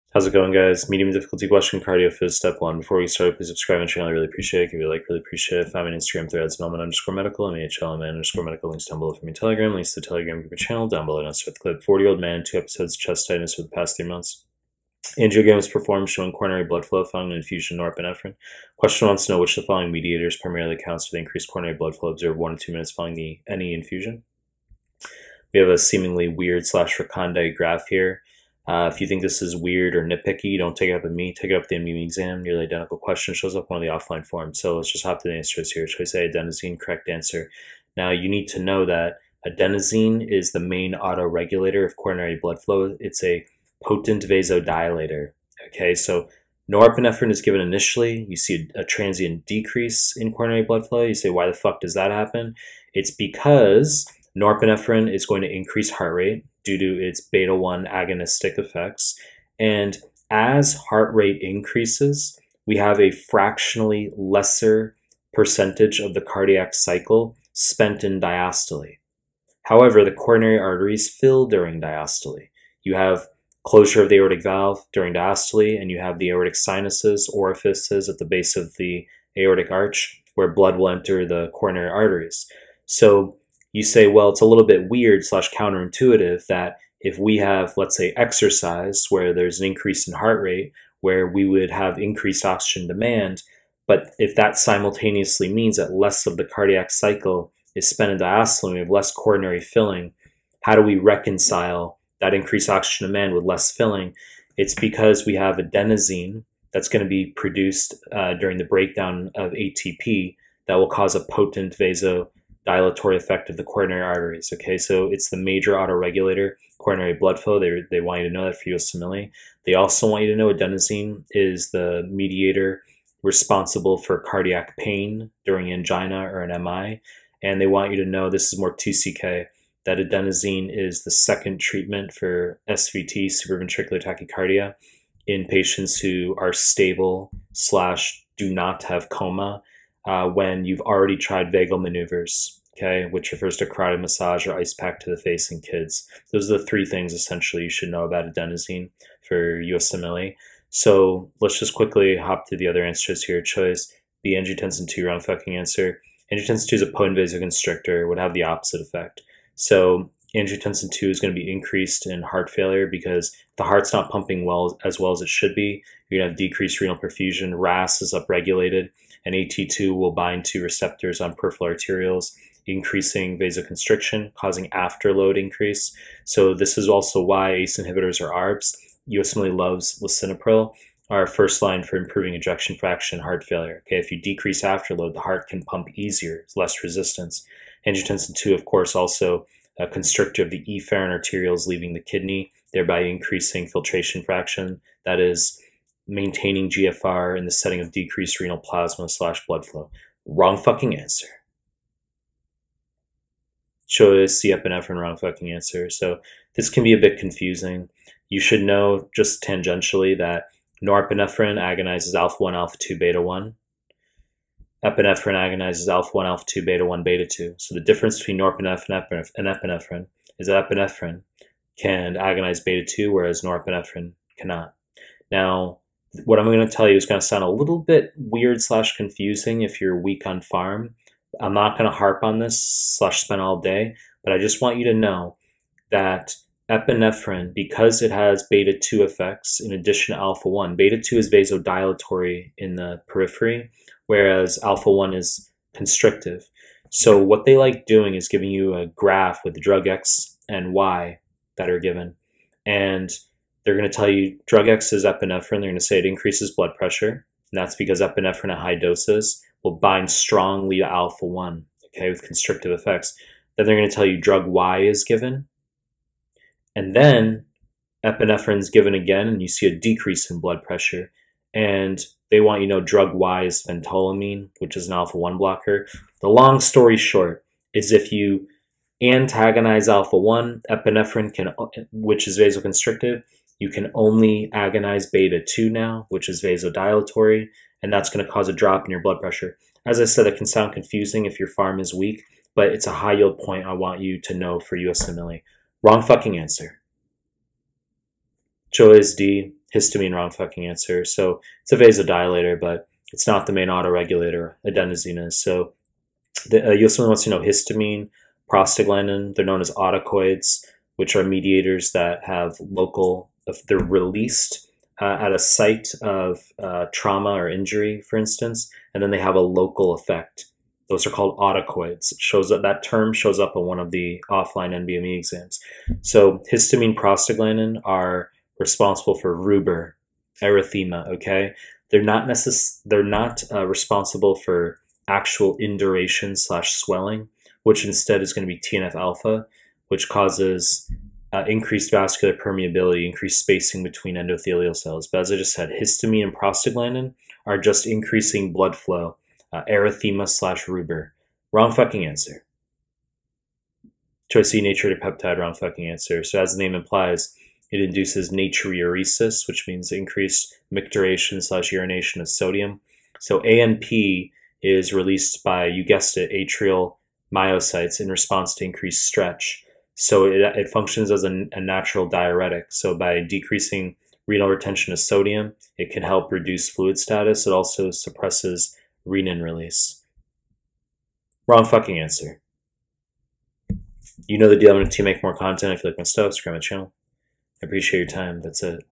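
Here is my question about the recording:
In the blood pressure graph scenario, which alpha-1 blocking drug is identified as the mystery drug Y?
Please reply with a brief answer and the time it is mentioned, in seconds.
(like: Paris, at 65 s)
Phentolamine, at 273 s.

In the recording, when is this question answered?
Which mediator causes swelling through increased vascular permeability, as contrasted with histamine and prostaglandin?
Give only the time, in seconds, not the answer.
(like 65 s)
338 s.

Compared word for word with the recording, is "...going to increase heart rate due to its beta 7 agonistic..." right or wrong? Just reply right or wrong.
wrong.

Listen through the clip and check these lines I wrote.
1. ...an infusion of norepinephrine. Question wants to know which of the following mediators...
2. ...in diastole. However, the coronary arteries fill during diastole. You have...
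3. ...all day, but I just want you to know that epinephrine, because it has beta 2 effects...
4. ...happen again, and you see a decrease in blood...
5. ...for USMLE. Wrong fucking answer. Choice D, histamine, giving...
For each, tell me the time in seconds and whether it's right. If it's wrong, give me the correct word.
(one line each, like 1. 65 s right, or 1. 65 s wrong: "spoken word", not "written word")
1. 17 s right
2. 68 s right
3. 233 s right
4. 268 s wrong: "given", not "happen"
5. 294 s wrong: "wrong", not "giving".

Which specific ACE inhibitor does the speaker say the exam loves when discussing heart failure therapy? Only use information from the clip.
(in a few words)
Lisinopril.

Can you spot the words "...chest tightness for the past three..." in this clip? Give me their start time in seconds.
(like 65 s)
12 s.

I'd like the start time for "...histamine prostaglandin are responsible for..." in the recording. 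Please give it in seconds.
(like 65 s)
326 s.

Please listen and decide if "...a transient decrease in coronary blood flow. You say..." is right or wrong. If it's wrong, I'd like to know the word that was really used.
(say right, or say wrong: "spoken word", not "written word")
right.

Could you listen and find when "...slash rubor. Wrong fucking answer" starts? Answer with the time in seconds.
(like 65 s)
350 s.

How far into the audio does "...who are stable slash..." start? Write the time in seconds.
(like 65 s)
135 s.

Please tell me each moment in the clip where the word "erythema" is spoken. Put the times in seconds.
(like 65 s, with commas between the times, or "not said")
330 s, 349 s.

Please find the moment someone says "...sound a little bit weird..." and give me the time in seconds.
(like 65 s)
227 s.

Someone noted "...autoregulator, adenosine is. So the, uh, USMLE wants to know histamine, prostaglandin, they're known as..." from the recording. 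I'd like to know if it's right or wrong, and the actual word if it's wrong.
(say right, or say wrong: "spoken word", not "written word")
right.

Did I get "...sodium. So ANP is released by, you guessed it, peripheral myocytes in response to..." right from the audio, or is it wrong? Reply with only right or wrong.
wrong.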